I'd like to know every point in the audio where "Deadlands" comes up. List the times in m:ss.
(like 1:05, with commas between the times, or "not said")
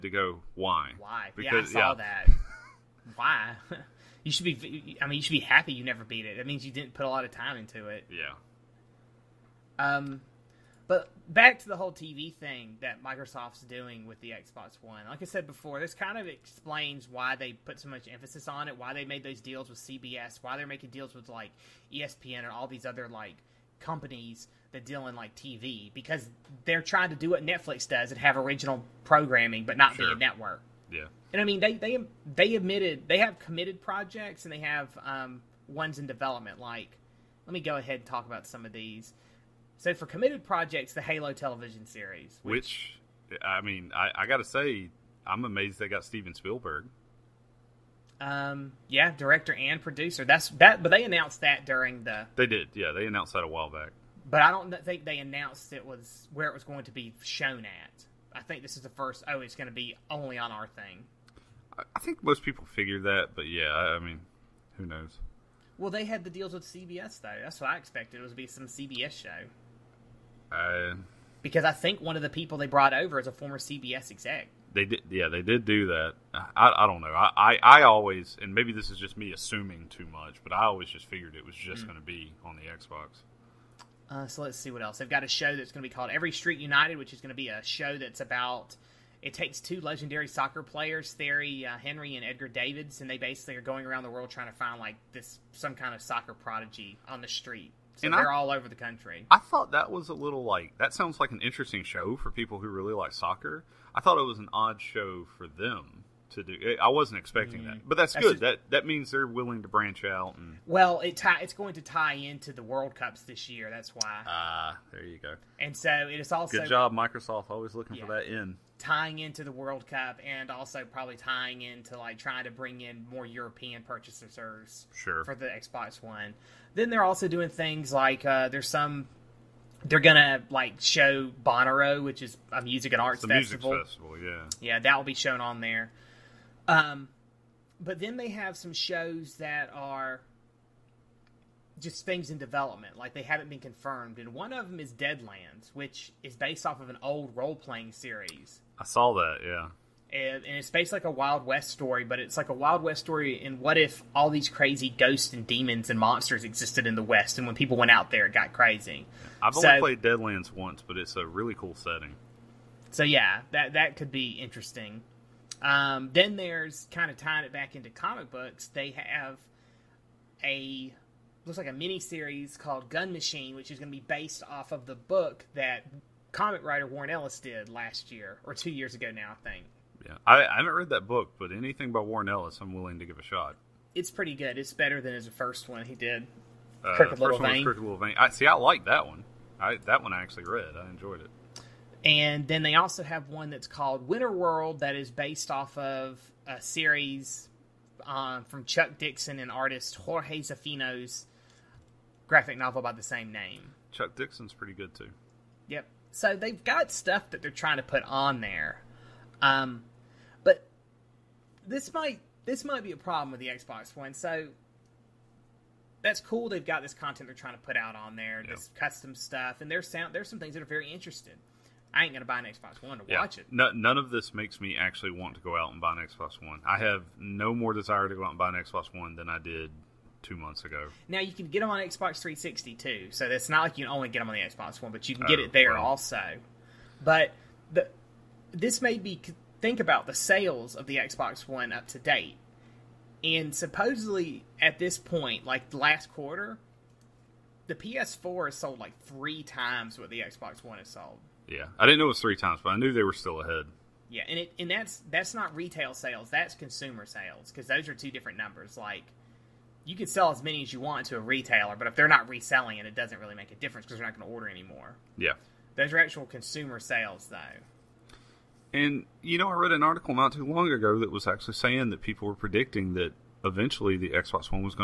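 2:24, 2:40.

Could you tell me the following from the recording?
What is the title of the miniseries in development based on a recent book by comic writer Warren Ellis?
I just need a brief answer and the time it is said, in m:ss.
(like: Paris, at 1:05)
Gun Machine, at 2:52.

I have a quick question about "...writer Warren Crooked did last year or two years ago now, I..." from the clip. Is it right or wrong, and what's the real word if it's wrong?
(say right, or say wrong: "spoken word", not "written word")
wrong: "Ellis", not "Crooked".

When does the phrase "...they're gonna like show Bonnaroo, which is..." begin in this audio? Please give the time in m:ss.
2:09.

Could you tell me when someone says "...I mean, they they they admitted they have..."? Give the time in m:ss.
0:31.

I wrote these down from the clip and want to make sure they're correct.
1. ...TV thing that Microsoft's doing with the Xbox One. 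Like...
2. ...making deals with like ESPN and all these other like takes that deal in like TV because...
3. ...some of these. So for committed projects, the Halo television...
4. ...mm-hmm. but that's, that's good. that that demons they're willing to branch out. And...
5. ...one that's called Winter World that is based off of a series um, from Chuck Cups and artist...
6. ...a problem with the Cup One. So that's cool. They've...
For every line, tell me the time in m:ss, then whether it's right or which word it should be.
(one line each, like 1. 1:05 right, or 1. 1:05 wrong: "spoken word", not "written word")
1. 0:11 right
2. 0:20 wrong: "companies", not "takes"
3. 0:38 right
4. 1:47 wrong: "means", not "demons"
5. 3:13 wrong: "Dixon", not "Cups"
6. 3:32 wrong: "Xbox", not "Cup".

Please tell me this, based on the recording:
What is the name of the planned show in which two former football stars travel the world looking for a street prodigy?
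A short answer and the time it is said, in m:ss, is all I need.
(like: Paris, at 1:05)
Every Street United, at 1:26.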